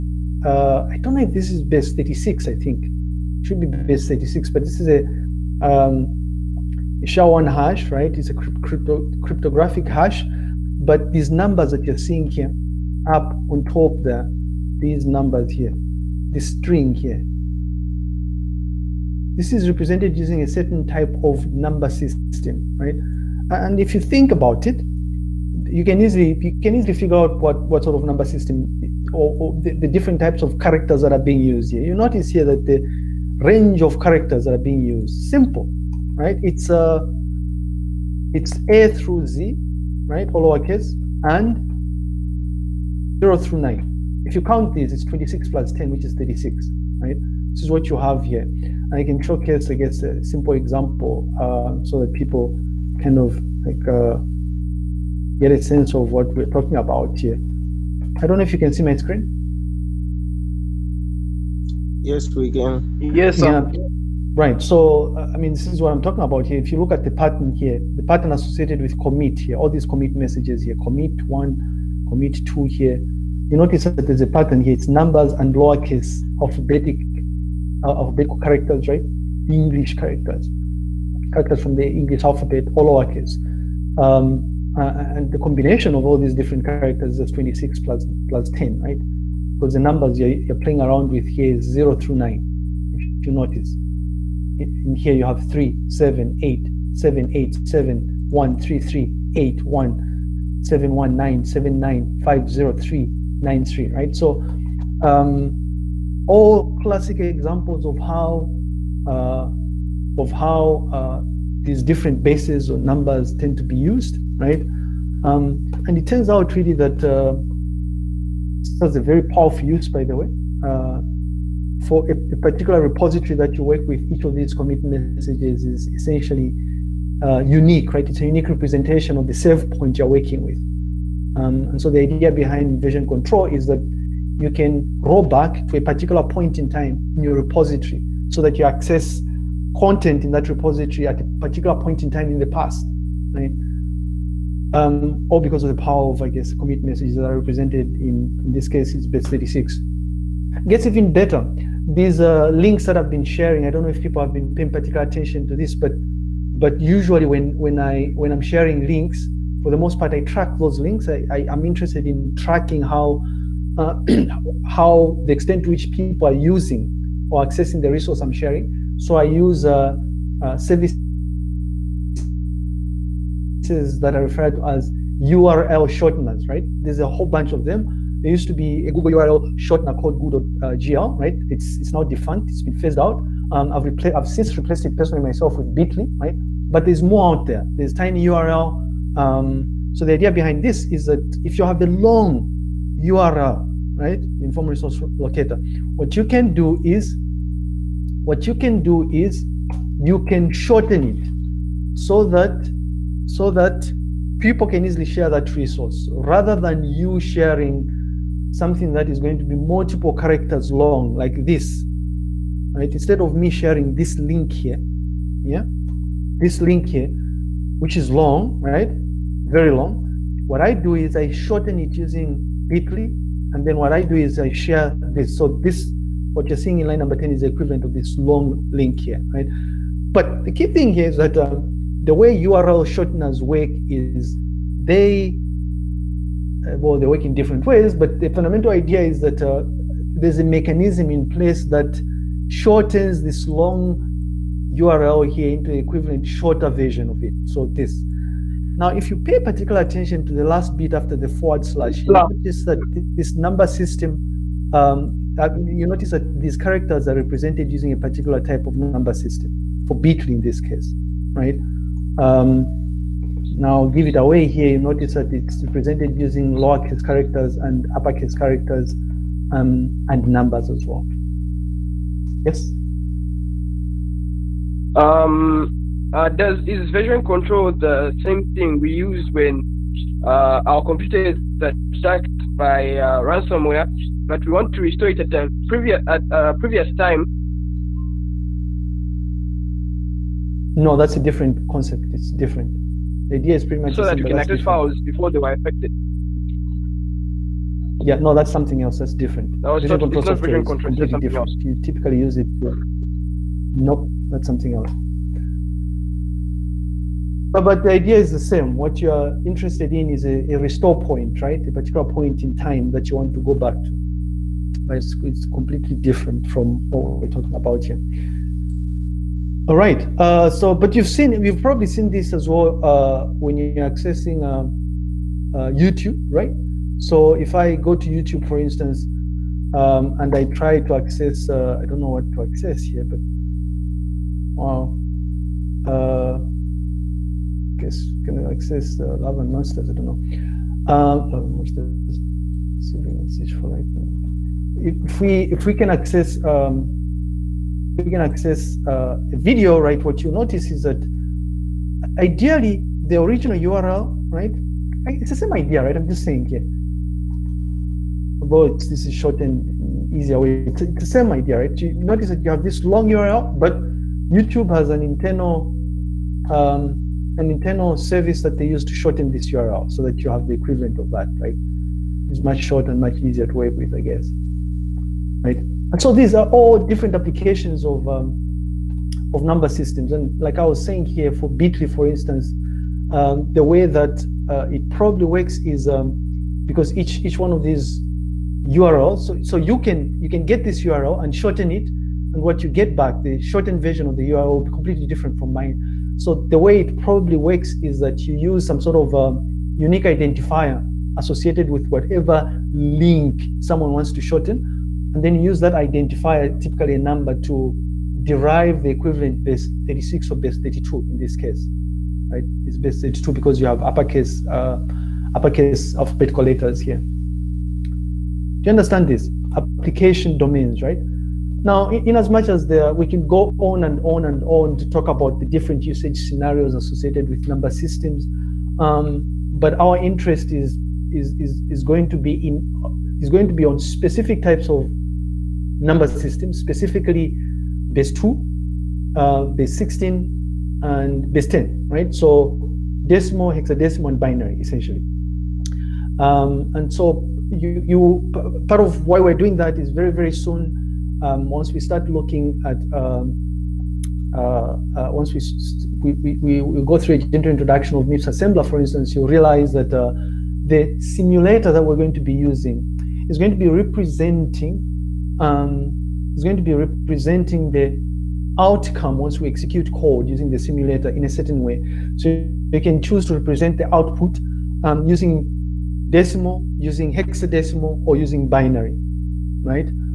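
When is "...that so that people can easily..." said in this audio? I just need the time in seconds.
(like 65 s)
202 s.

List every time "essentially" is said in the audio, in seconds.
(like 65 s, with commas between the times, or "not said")
125 s, 444 s.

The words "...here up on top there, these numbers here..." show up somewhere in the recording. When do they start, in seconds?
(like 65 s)
12 s.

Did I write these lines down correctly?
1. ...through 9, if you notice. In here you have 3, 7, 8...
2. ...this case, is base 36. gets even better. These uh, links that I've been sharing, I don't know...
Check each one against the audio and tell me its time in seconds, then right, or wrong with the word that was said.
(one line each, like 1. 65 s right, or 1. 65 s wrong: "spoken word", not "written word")
1. 91 s right
2. 148 s right.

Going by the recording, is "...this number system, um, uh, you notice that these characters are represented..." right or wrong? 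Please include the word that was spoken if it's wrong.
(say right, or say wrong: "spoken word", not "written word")
right.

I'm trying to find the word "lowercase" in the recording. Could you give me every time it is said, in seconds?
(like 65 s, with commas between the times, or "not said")
40 s, 75 s, 82 s, 266 s.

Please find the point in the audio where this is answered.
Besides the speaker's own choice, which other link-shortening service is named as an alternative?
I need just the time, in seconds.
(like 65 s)
187 s.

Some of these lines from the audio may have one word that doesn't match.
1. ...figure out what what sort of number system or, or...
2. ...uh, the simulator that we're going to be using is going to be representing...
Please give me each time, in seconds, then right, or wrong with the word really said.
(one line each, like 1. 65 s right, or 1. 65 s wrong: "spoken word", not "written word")
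1. 26 s right
2. 459 s right.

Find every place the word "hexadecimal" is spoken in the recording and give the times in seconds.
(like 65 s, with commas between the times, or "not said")
443 s, 477 s.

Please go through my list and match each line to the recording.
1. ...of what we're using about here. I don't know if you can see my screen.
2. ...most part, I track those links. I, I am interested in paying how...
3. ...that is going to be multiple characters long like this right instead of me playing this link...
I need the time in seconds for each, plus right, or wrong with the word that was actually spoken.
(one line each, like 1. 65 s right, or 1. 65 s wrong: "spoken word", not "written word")
1. 55 s wrong: "talking", not "using"
2. 159 s wrong: "tracking", not "paying"
3. 208 s wrong: "sharing", not "playing".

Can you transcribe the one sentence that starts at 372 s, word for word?
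It's much shorter and much easier to work with, I guess, right?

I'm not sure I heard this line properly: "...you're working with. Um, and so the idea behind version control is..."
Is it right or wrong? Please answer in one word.
right.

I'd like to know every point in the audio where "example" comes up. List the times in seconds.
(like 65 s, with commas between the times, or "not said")
50 s, 107 s.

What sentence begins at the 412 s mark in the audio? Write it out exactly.
It's base 32 because you have uppercase, uh, uppercase alphabetical letters here.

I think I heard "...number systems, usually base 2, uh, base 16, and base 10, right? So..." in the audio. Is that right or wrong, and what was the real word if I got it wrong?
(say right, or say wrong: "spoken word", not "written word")
wrong: "specifically", not "usually".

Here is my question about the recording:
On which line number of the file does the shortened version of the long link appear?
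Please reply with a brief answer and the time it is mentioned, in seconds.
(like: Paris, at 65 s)
10, at 226 s.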